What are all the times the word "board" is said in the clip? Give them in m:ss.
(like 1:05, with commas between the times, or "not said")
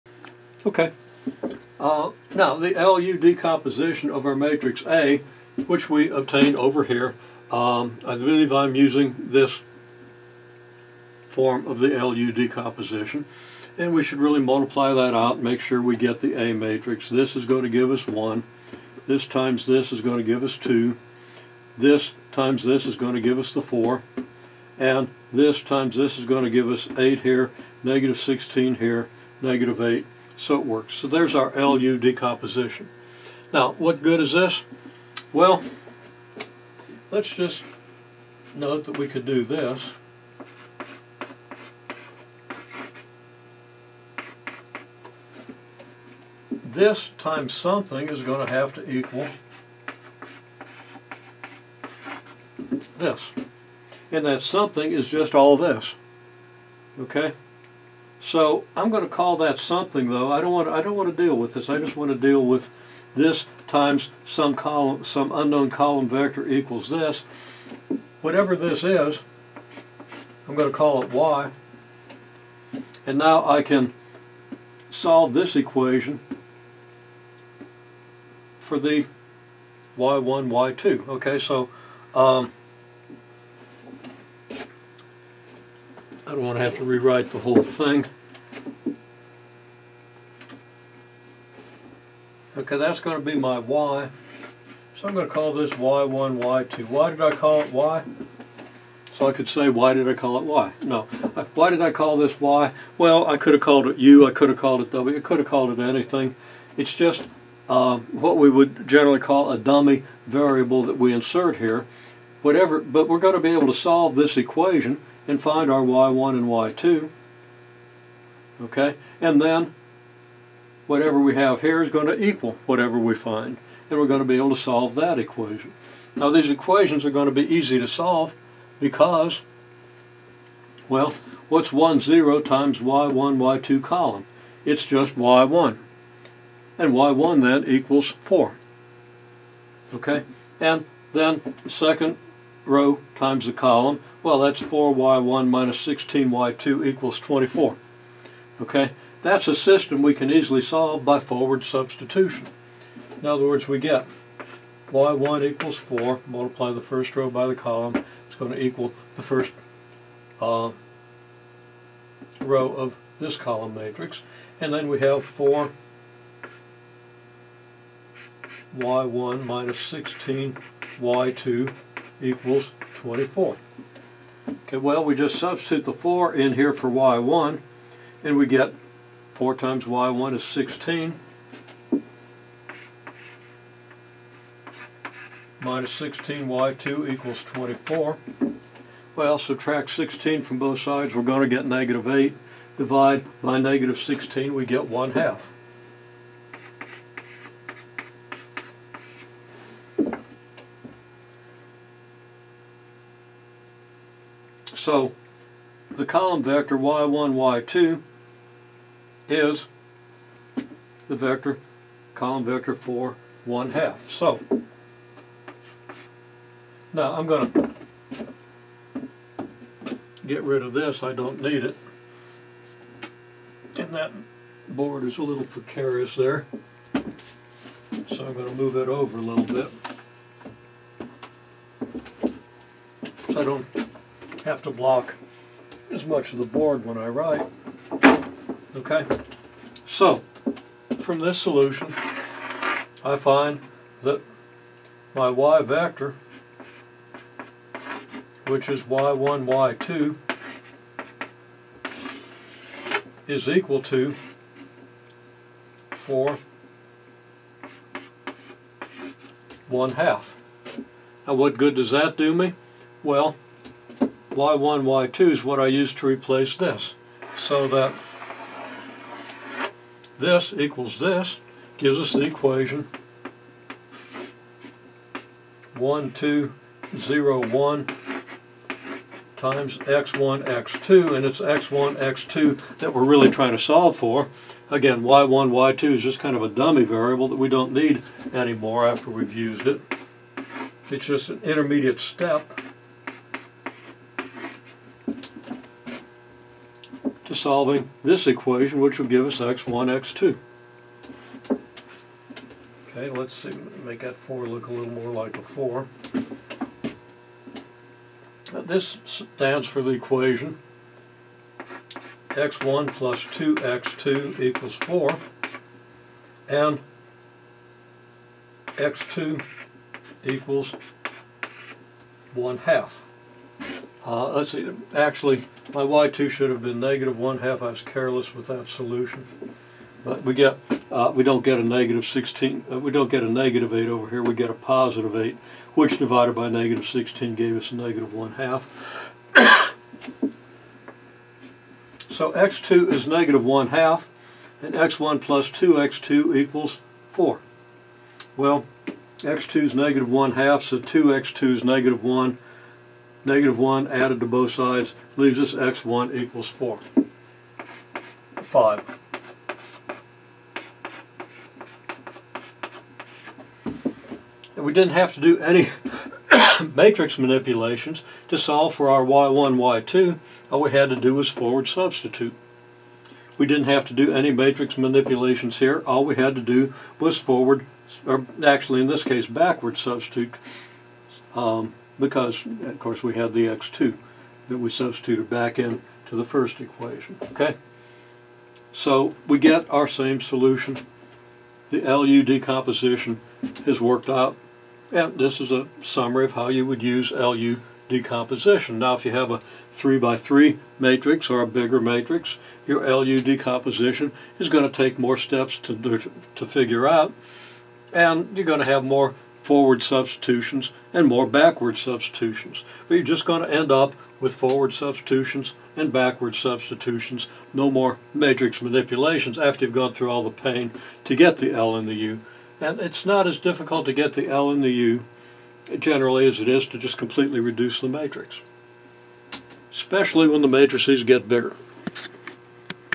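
3:44, 3:56.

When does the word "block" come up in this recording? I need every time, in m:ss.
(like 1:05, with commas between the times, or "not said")
3:54.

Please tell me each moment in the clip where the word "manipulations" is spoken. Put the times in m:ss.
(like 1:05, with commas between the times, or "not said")
6:07, 6:14, 6:58.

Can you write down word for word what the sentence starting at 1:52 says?
Whatever, but we're going to be able to solve this equation and find our y1 and y2.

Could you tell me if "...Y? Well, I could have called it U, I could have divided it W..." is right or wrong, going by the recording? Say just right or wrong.
wrong.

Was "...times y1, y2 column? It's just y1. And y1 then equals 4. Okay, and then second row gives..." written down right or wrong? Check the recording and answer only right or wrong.
wrong.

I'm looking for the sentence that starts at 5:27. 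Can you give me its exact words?
I was careless with that solution.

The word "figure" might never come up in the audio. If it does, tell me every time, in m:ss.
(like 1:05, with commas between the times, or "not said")
6:46.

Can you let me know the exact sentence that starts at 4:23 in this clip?
Well, Y1, Y2 is what I use to replace this.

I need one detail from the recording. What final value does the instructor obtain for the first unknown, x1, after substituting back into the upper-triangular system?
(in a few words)
5.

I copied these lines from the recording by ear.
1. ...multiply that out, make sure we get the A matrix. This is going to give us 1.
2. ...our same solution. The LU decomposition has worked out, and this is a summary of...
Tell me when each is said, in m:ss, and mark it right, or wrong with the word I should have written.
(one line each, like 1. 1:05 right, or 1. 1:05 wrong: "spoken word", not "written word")
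1. 0:14 right
2. 6:29 right.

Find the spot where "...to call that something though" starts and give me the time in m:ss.
0:59.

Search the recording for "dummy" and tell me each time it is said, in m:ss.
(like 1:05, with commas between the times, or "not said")
1:49, 4:46.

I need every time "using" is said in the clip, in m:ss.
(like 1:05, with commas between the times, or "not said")
0:08.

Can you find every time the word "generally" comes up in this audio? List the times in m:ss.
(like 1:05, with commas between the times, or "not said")
1:48, 7:05.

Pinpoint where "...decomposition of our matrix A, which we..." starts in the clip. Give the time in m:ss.
0:03.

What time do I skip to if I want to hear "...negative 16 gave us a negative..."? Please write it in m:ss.
5:36.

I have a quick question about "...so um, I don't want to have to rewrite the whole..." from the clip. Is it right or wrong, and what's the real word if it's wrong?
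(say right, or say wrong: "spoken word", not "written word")
right.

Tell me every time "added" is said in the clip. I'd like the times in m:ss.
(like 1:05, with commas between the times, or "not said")
5:53.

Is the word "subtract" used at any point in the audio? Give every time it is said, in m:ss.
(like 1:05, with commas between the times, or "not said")
3:09.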